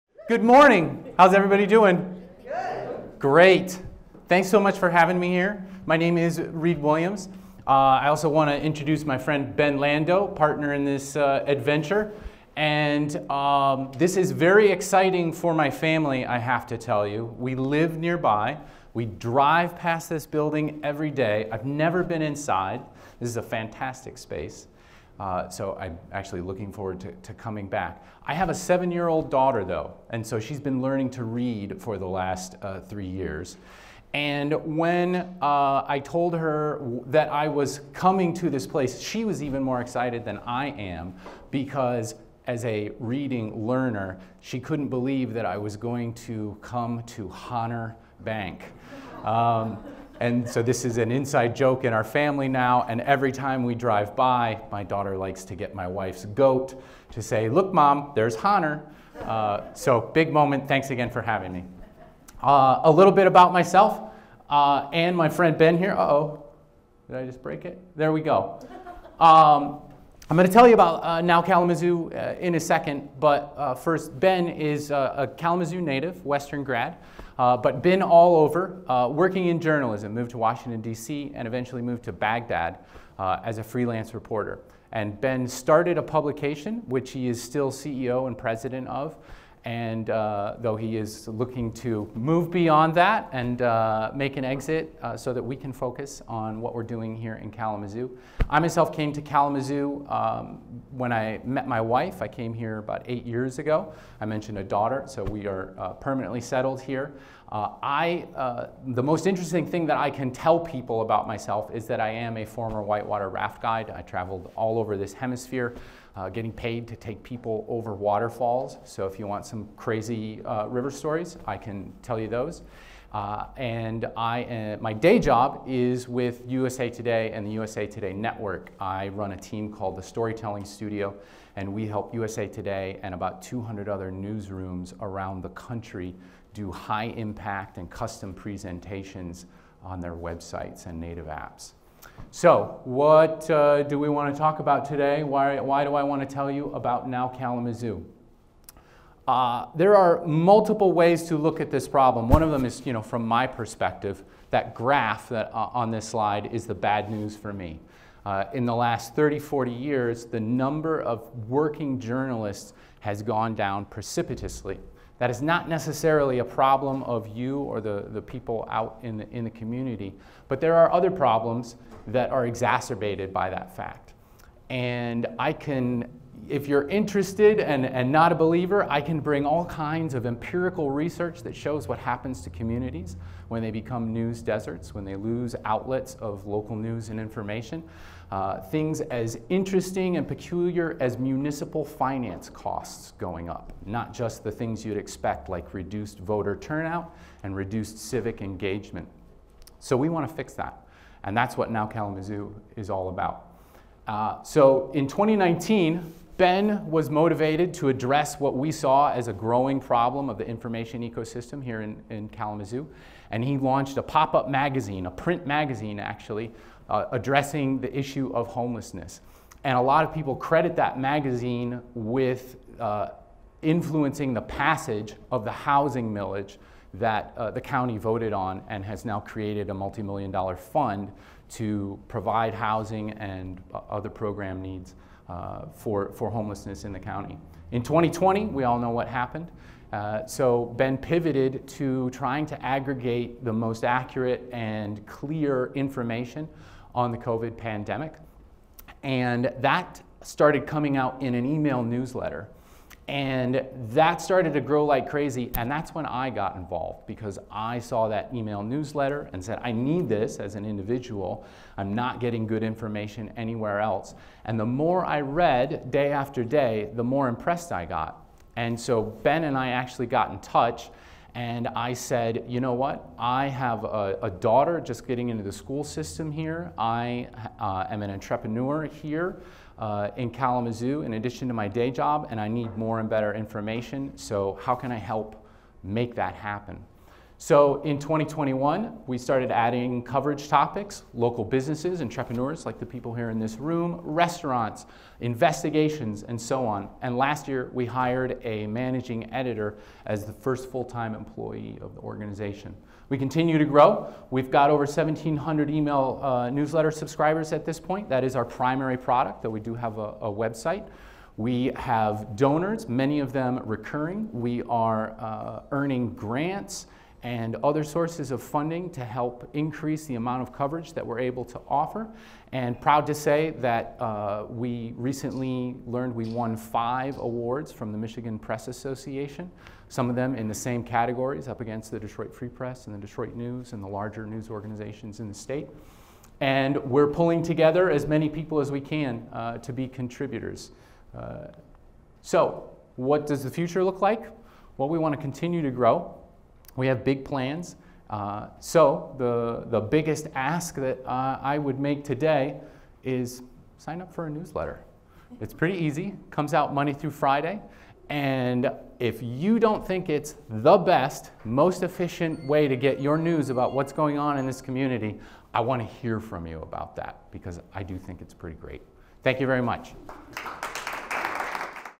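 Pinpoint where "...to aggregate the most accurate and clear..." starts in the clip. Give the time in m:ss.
4:02.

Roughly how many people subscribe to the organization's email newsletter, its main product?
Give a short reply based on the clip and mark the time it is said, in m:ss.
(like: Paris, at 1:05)
Over 1,700, at 5:04.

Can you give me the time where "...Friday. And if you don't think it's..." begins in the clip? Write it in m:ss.
5:57.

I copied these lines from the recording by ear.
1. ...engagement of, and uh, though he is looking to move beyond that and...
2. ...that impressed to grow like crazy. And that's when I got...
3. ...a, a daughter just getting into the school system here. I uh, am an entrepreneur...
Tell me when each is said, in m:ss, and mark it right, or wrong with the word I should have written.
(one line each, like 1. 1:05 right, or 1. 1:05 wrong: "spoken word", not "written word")
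1. 1:28 wrong: "president", not "engagement"
2. 4:13 wrong: "started", not "impressed"
3. 4:33 right.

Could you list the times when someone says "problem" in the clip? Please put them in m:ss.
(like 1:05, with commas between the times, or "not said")
2:31, 2:46, 2:51, 3:29.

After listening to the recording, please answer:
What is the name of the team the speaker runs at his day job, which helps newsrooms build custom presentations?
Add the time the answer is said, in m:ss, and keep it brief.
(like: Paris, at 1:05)
Storytelling Studio, at 2:10.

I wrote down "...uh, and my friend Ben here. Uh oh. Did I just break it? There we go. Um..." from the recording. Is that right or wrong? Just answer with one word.
right.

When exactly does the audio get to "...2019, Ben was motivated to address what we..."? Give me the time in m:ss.
3:25.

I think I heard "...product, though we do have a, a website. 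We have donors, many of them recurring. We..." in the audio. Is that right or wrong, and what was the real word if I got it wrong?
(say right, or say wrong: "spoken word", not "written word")
right.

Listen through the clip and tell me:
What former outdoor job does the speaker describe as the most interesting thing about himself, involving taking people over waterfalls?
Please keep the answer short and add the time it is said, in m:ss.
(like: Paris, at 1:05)
Whitewater raft guide, at 1:52.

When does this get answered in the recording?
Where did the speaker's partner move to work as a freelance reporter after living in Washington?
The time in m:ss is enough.
1:22.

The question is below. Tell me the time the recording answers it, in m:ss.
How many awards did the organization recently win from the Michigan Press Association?
5:26.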